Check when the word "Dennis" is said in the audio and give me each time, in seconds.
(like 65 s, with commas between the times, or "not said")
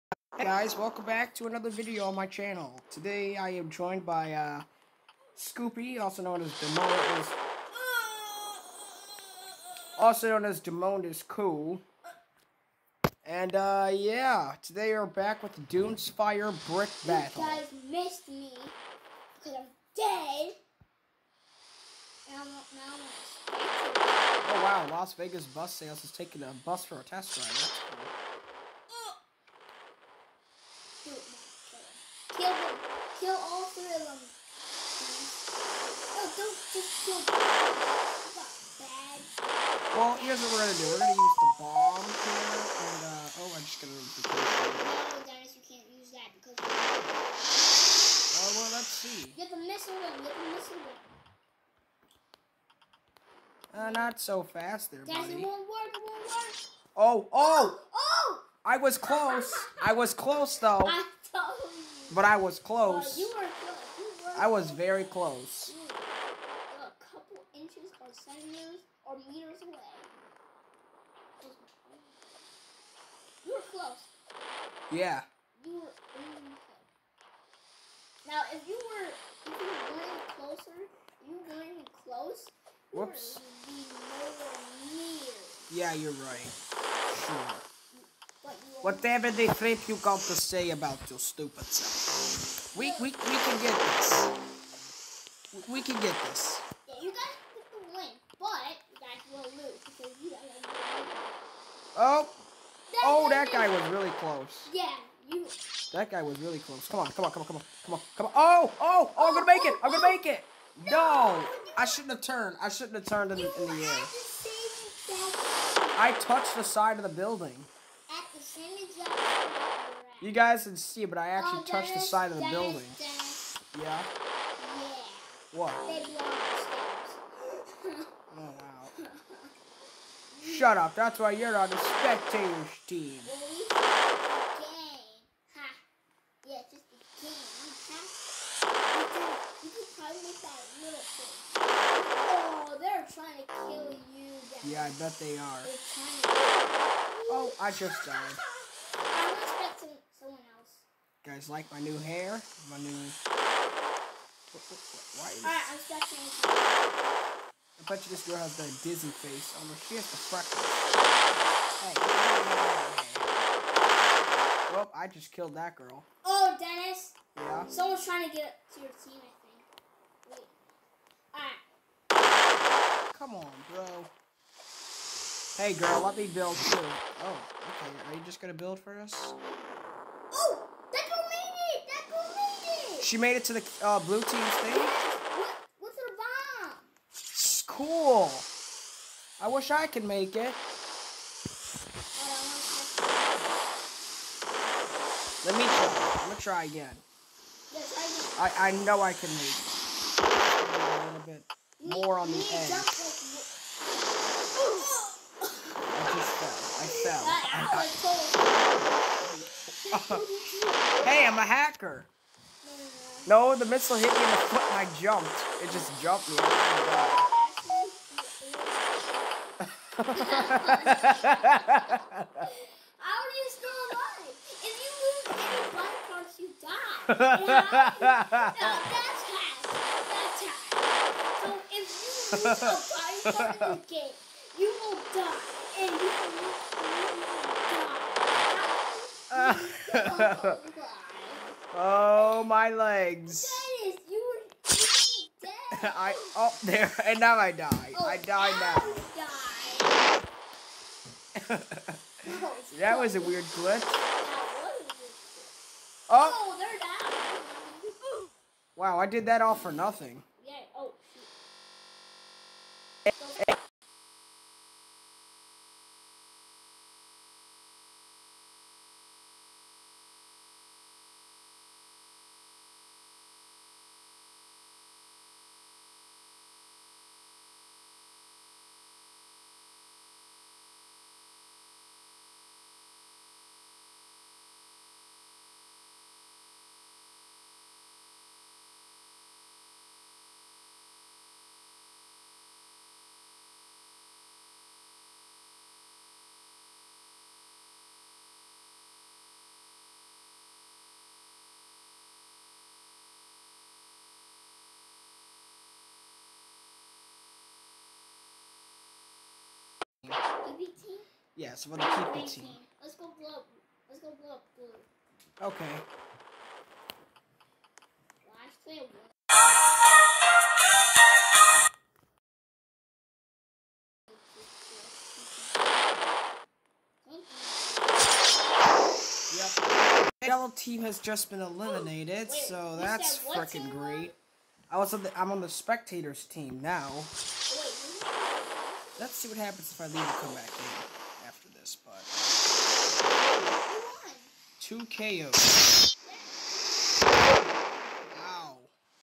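45 s, 166 s, 243 s.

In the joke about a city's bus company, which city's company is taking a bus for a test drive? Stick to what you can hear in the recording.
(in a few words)
Las Vegas.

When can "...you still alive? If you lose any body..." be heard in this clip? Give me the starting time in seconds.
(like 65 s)
223 s.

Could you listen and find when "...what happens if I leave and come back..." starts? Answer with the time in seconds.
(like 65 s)
339 s.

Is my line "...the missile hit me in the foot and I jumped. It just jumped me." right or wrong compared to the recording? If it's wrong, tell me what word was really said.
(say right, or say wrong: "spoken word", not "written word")
right.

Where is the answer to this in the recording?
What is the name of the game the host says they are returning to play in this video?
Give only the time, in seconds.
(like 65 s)
15 s.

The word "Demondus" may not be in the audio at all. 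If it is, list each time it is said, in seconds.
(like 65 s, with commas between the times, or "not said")
6 s, 10 s.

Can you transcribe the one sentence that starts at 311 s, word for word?
Yeah, so for the PP team.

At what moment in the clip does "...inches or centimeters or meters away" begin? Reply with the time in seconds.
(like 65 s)
67 s.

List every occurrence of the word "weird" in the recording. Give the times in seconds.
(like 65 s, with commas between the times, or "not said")
253 s.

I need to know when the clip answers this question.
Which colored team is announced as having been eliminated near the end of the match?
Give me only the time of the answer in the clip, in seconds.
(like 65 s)
330 s.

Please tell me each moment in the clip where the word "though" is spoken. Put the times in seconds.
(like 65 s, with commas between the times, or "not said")
60 s.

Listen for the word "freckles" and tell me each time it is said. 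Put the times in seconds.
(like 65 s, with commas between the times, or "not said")
160 s.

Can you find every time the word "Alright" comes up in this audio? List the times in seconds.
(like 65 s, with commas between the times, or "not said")
153 s, 172 s.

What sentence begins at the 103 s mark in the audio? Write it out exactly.
oh, that oh, guy was really close.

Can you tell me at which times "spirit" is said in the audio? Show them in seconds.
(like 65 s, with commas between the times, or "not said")
not said.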